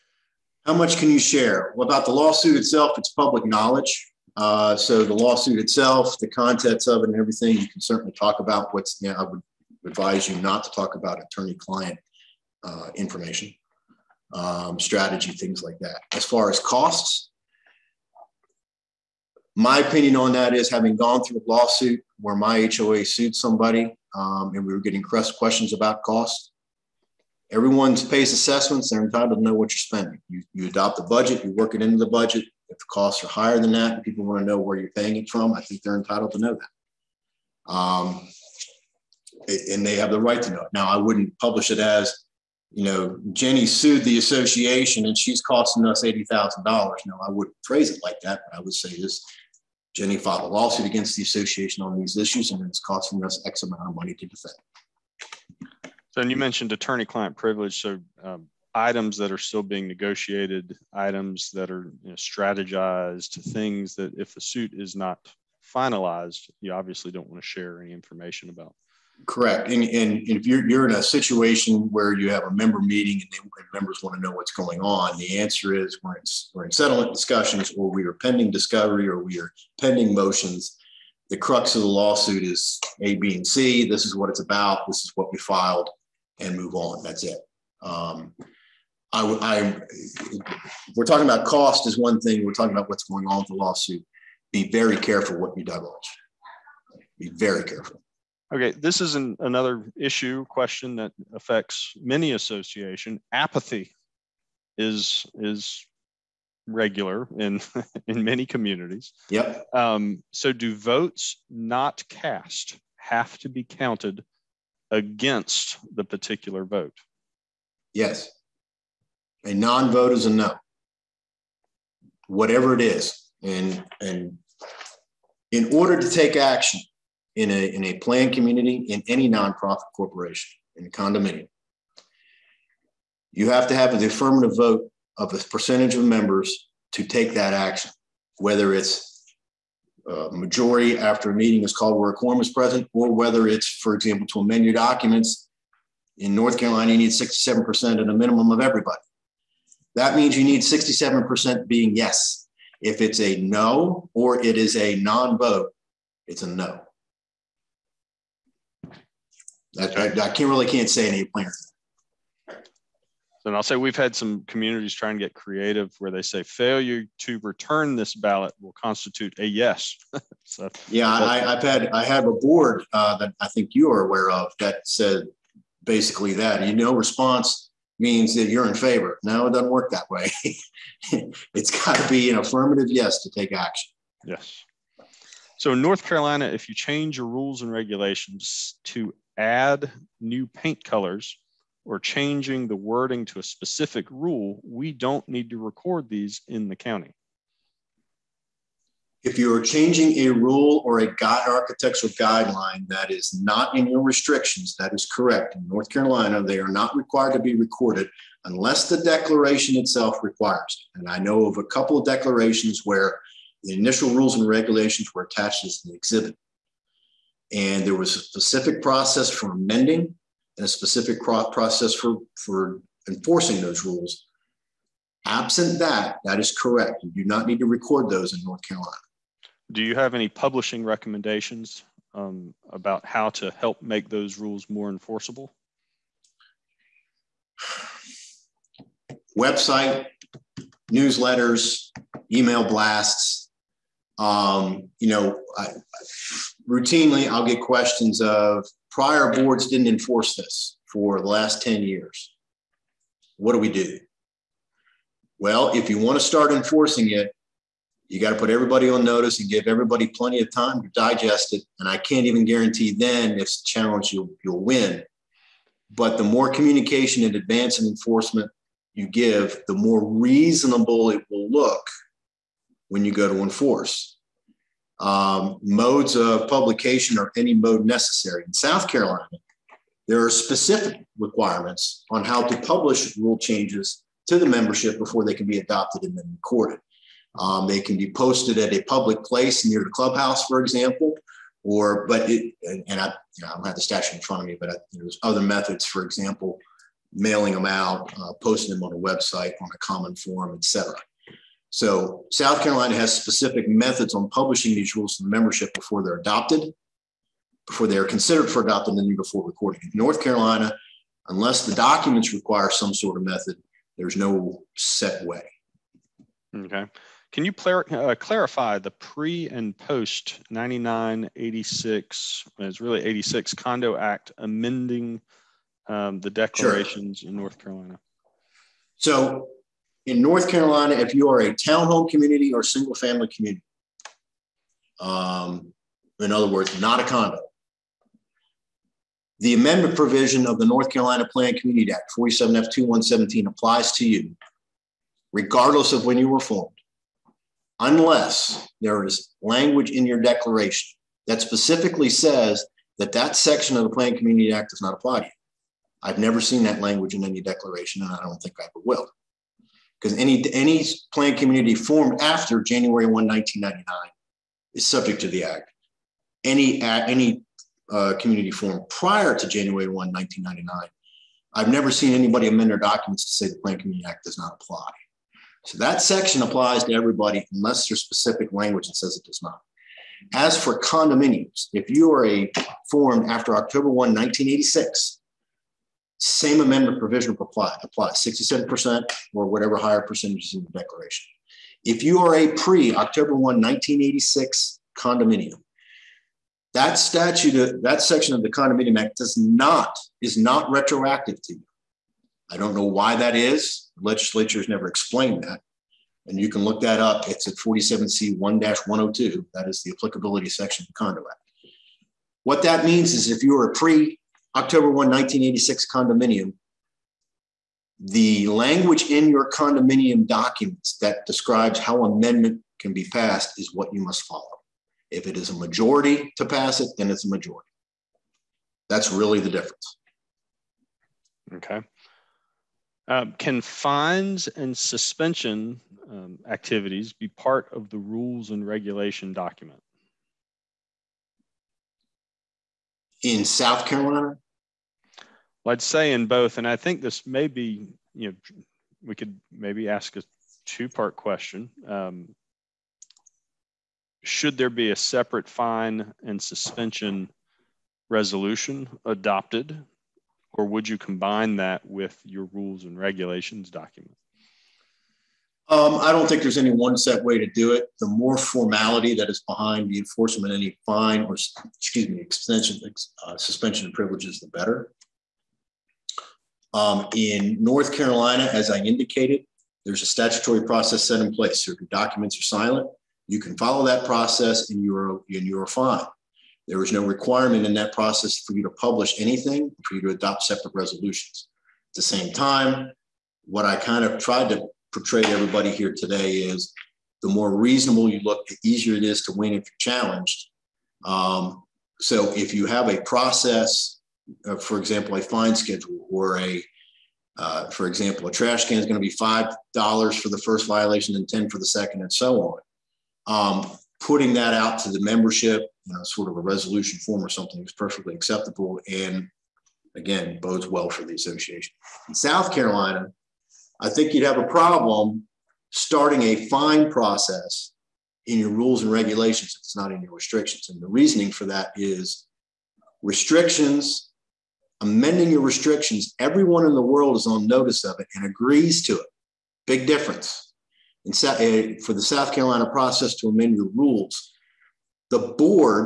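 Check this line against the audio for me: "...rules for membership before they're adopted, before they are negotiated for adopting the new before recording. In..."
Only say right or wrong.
wrong.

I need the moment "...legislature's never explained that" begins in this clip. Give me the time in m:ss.
6:44.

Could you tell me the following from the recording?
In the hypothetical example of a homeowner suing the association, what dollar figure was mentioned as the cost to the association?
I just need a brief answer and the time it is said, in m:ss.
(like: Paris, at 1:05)
$80,000, at 0:46.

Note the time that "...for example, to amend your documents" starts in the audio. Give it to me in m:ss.
2:23.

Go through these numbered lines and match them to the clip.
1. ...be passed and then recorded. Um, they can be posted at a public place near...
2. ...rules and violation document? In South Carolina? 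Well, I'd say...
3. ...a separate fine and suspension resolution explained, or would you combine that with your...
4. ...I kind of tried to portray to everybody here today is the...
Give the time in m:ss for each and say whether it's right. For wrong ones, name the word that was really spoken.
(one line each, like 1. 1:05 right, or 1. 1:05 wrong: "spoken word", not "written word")
1. 4:45 wrong: "adopted", not "passed"
2. 7:17 wrong: "regulation", not "violation"
3. 7:34 wrong: "adopted", not "explained"
4. 8:13 right.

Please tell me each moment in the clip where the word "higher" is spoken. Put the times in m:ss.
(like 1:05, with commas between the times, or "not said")
0:33, 6:29.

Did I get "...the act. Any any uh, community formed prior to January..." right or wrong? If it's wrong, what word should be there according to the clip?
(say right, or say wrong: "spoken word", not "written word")
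right.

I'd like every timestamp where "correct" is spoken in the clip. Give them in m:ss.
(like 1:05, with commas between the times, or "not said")
1:09, 3:25, 3:46.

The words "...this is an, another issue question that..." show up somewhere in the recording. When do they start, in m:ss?
1:38.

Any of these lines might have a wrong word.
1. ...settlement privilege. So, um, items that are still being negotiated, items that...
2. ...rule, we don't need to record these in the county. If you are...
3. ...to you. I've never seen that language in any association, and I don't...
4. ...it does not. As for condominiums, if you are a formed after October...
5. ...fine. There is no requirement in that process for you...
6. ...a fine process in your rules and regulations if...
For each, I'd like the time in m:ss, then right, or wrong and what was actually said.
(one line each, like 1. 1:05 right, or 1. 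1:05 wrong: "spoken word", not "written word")
1. 0:57 wrong: "client", not "settlement"
2. 3:14 right
3. 5:55 wrong: "declaration", not "association"
4. 6:19 right
5. 8:05 right
6. 8:46 right.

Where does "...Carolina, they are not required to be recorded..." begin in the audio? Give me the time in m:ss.
3:25.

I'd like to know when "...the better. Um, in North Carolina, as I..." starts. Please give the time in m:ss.
7:54.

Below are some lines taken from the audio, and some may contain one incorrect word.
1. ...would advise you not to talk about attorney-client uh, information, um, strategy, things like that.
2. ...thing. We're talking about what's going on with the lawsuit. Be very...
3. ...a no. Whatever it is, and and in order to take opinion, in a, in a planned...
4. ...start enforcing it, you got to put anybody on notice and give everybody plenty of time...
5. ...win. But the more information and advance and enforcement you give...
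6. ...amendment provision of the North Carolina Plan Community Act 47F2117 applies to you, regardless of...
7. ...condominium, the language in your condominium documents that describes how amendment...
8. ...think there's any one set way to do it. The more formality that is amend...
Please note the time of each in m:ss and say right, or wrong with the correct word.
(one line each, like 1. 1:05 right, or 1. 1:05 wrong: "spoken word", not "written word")
1. 0:09 right
2. 1:32 right
3. 2:00 wrong: "action", not "opinion"
4. 4:16 wrong: "everybody", not "anybody"
5. 4:24 wrong: "communication", not "information"
6. 5:39 right
7. 6:55 right
8. 7:46 wrong: "behind", not "amend".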